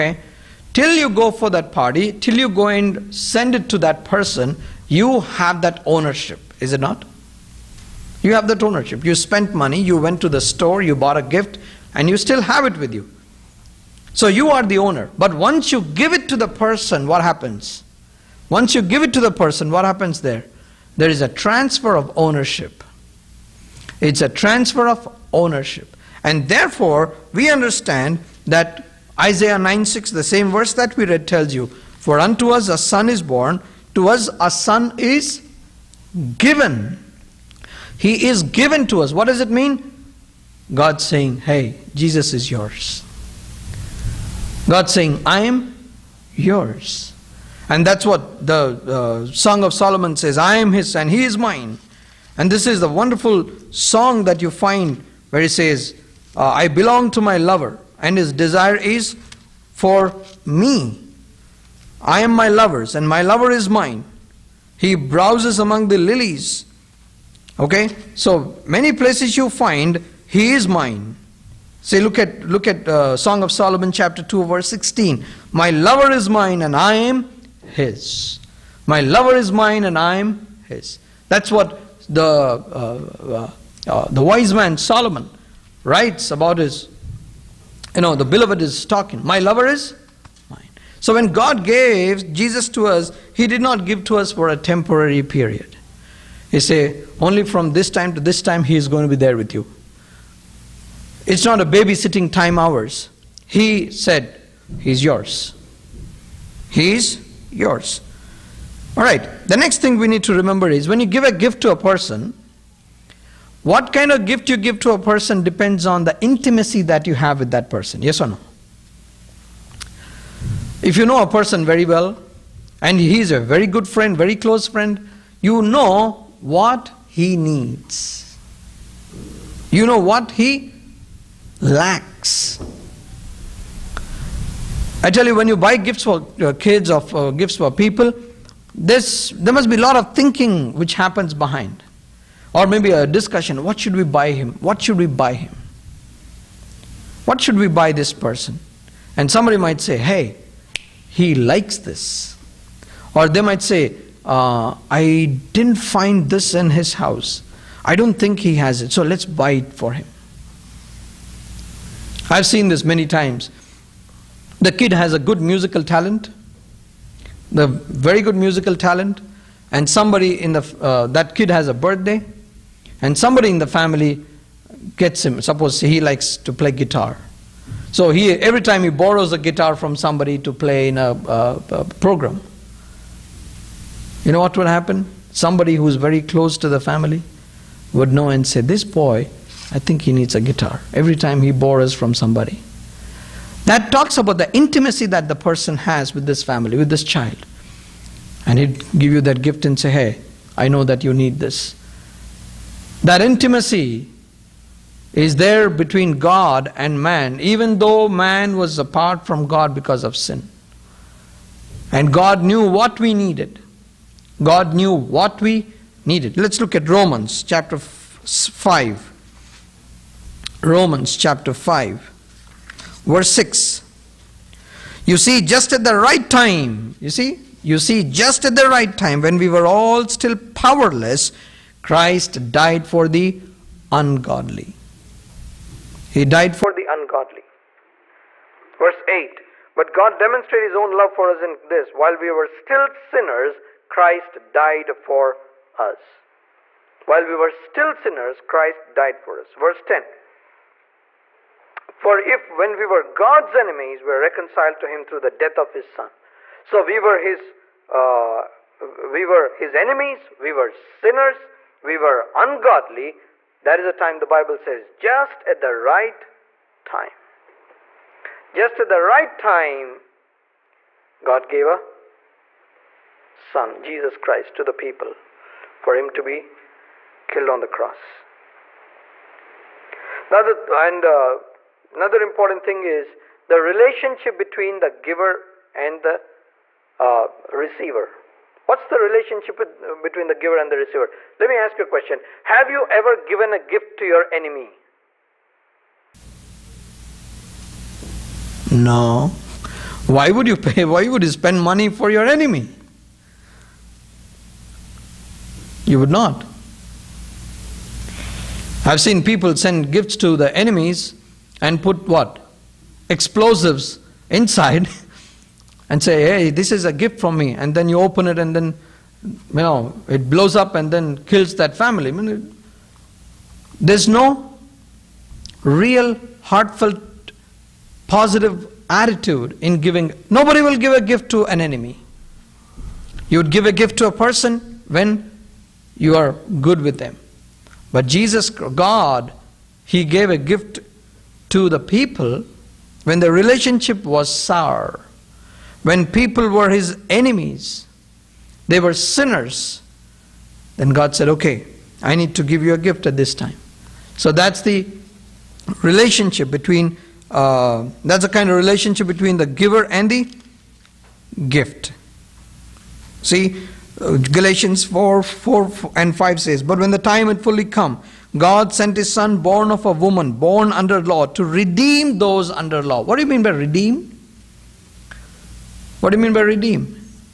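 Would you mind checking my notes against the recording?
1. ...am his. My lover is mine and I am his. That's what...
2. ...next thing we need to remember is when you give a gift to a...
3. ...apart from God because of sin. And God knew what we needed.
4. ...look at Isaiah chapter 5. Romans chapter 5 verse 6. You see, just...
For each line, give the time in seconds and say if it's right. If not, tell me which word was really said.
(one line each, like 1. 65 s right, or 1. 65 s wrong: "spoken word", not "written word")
1. 76 s right
2. 109 s right
3. 208 s right
4. 216 s wrong: "Romans", not "Isaiah".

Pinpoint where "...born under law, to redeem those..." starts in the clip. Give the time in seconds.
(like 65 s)
370 s.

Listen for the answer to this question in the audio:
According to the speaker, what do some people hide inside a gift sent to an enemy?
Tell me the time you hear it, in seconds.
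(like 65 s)
313 s.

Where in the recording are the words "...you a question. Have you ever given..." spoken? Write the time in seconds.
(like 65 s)
291 s.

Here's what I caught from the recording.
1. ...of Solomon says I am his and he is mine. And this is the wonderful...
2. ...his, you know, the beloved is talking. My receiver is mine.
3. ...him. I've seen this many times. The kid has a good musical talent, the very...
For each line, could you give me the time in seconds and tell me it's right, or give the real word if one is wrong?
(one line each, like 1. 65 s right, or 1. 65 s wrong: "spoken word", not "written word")
1. 49 s right
2. 86 s wrong: "lover", not "receiver"
3. 159 s right.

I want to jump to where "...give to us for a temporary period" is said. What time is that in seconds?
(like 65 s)
93 s.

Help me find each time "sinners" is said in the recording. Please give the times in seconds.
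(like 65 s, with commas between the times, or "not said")
242 s, 247 s, 260 s, 348 s.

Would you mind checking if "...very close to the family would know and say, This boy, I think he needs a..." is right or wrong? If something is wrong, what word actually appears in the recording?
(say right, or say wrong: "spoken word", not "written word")
right.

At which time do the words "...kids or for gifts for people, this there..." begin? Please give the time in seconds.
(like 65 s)
136 s.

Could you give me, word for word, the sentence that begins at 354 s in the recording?
So that's the relationship between, uh, that's the kind of relationship between the giver and the gift.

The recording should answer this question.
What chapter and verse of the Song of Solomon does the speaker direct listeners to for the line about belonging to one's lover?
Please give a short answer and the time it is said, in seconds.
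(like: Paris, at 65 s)
Chapter 2, verse 16, at 73 s.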